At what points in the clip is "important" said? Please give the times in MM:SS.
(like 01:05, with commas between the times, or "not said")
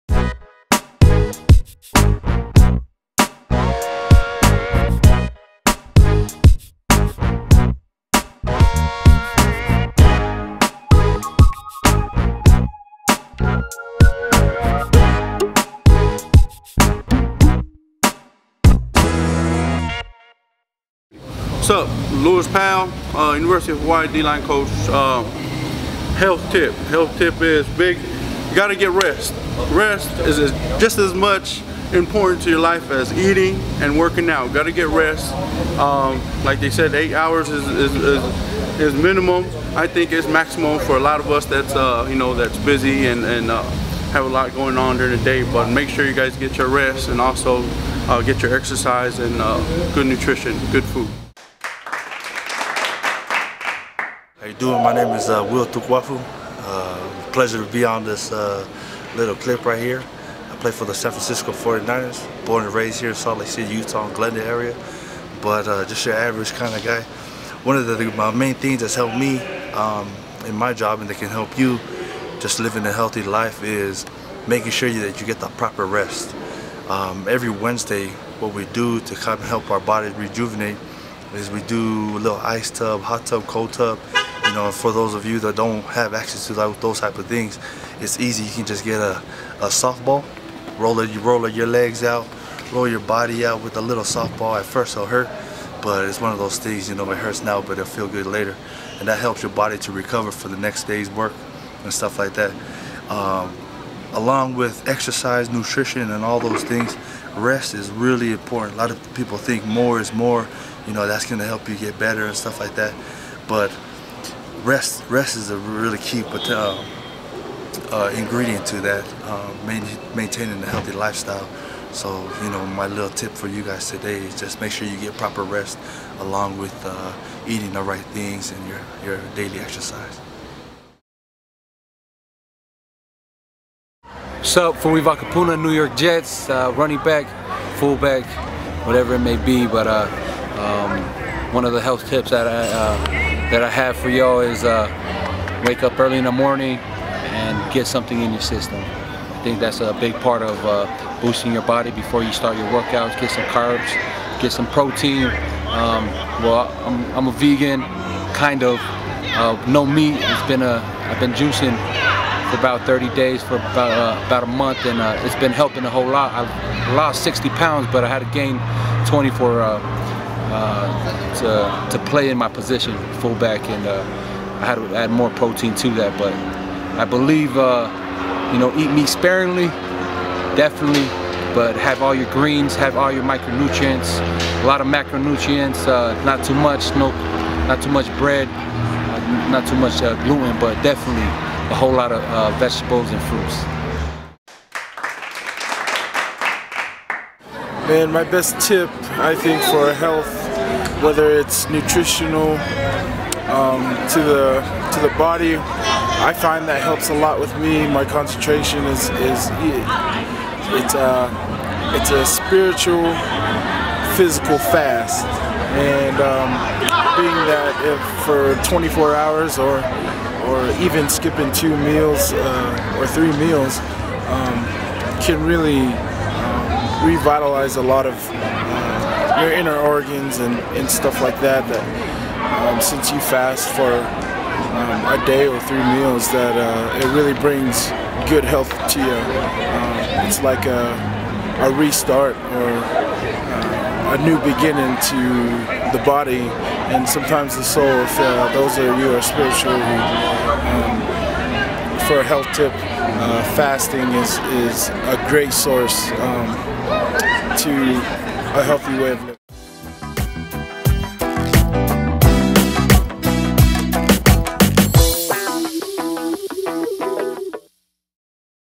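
00:31, 01:48.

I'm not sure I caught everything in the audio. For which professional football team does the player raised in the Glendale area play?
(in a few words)
San Francisco 49ers.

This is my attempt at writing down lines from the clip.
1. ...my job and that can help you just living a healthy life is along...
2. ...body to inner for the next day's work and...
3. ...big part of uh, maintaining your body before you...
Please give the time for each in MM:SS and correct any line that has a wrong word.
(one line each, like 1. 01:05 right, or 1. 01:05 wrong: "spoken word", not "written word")
1. 01:10 wrong: "making", not "along"
2. 01:39 wrong: "recover", not "inner"
3. 02:29 wrong: "boosting", not "maintaining".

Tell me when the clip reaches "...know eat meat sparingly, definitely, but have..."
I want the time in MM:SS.
02:58.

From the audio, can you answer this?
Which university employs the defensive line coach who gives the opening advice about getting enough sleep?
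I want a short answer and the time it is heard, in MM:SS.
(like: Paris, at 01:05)
University of Hawaii, at 00:23.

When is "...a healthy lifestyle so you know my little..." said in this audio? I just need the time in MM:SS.
02:00.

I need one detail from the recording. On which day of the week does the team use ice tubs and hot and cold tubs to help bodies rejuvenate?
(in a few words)
Wednesday.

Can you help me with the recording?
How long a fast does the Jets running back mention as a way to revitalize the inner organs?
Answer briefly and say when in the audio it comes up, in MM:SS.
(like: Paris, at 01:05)
24 hours, at 03:38.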